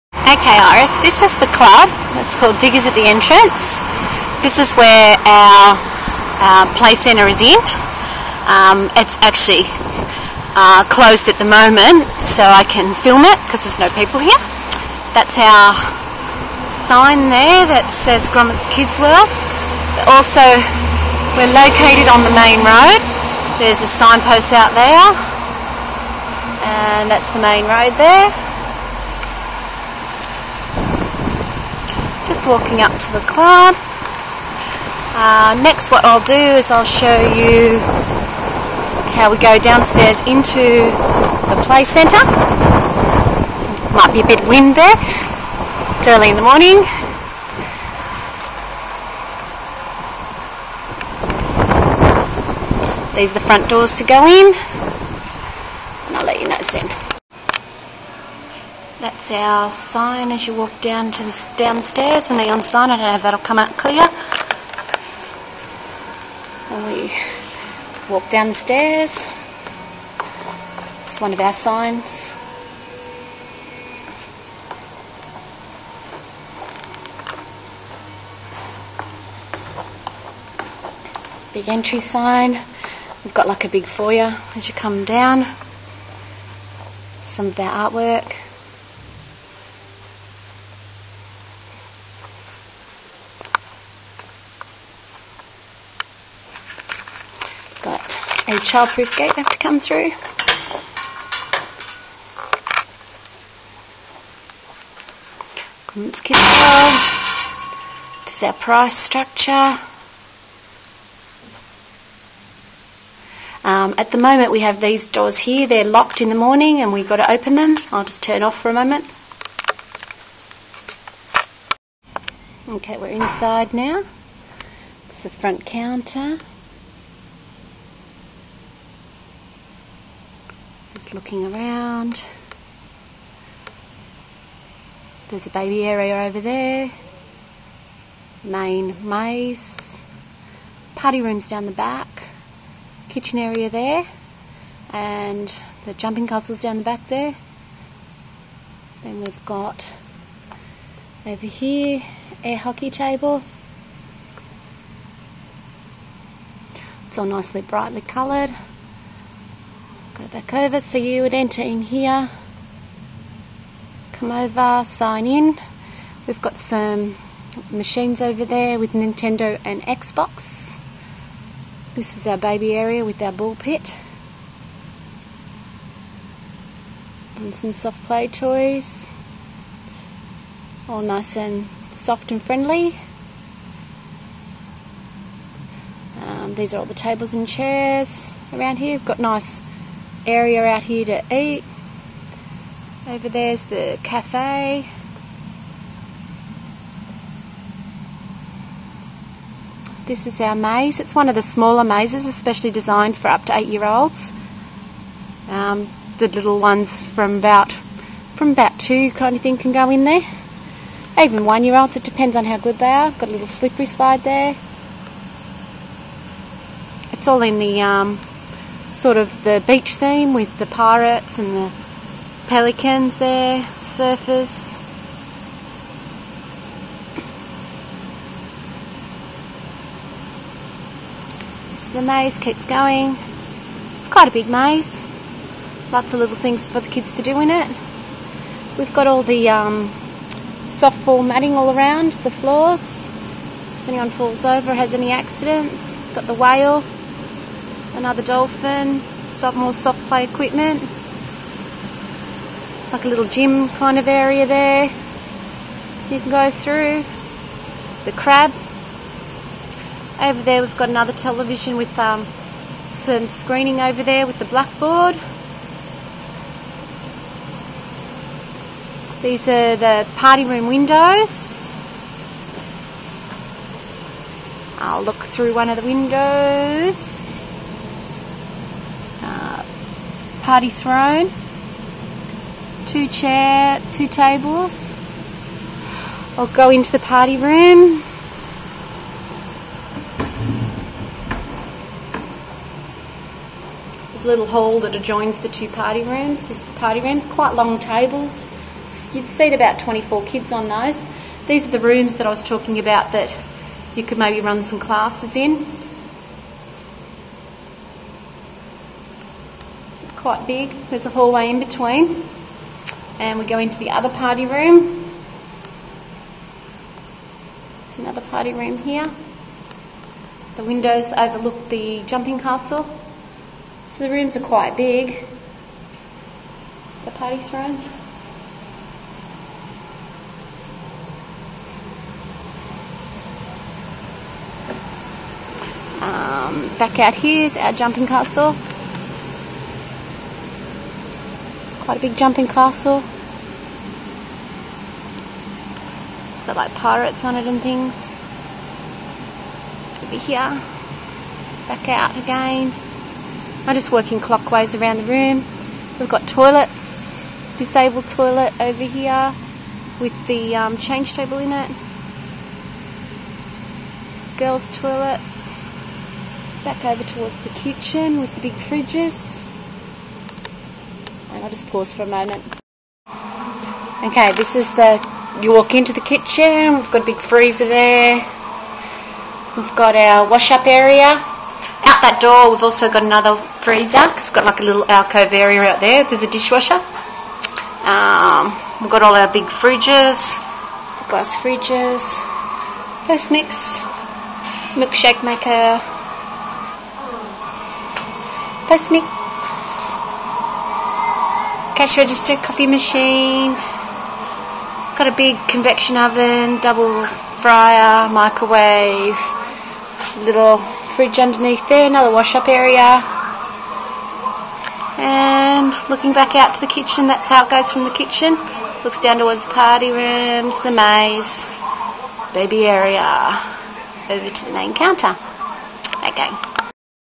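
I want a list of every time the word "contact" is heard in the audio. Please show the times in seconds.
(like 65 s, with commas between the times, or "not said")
not said.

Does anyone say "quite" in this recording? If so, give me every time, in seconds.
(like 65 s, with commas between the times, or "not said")
234 s, 297 s, 310 s, 324 s.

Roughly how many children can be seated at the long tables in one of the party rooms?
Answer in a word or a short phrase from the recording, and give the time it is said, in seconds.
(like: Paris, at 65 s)
24, at 299 s.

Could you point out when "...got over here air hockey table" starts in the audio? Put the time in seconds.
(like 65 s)
149 s.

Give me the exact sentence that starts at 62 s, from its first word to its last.
I don't know if that'll come out clear.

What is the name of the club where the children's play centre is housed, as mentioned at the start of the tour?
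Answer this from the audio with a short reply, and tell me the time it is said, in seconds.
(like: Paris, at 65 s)
Diggers, at 2 s.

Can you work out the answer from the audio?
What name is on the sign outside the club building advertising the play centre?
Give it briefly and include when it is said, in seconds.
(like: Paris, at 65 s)
Grommets Kids World, at 18 s.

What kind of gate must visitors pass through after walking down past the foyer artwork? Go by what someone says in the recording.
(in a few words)
A childproof gate.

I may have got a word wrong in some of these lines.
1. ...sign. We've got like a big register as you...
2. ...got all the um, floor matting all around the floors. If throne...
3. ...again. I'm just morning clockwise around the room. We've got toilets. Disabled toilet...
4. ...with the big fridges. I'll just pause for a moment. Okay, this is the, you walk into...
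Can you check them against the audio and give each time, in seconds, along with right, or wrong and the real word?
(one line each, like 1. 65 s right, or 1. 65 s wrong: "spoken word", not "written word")
1. 81 s wrong: "foyer", not "register"
2. 238 s wrong: "anyone", not "throne"
3. 352 s wrong: "working", not "morning"
4. 368 s right.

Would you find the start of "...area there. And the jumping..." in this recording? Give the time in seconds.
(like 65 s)
143 s.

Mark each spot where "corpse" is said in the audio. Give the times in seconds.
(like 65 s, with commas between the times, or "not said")
not said.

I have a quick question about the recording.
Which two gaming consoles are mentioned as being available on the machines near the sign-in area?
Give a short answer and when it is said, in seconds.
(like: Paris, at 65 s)
Nintendo and Xbox, at 168 s.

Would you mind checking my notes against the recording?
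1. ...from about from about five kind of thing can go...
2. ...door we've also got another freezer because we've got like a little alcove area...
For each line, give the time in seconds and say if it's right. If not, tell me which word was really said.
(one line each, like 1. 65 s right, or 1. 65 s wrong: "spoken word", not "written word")
1. 207 s wrong: "two", not "five"
2. 382 s right.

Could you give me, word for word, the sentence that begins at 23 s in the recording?
There's a signpost out there, and that's the main road there.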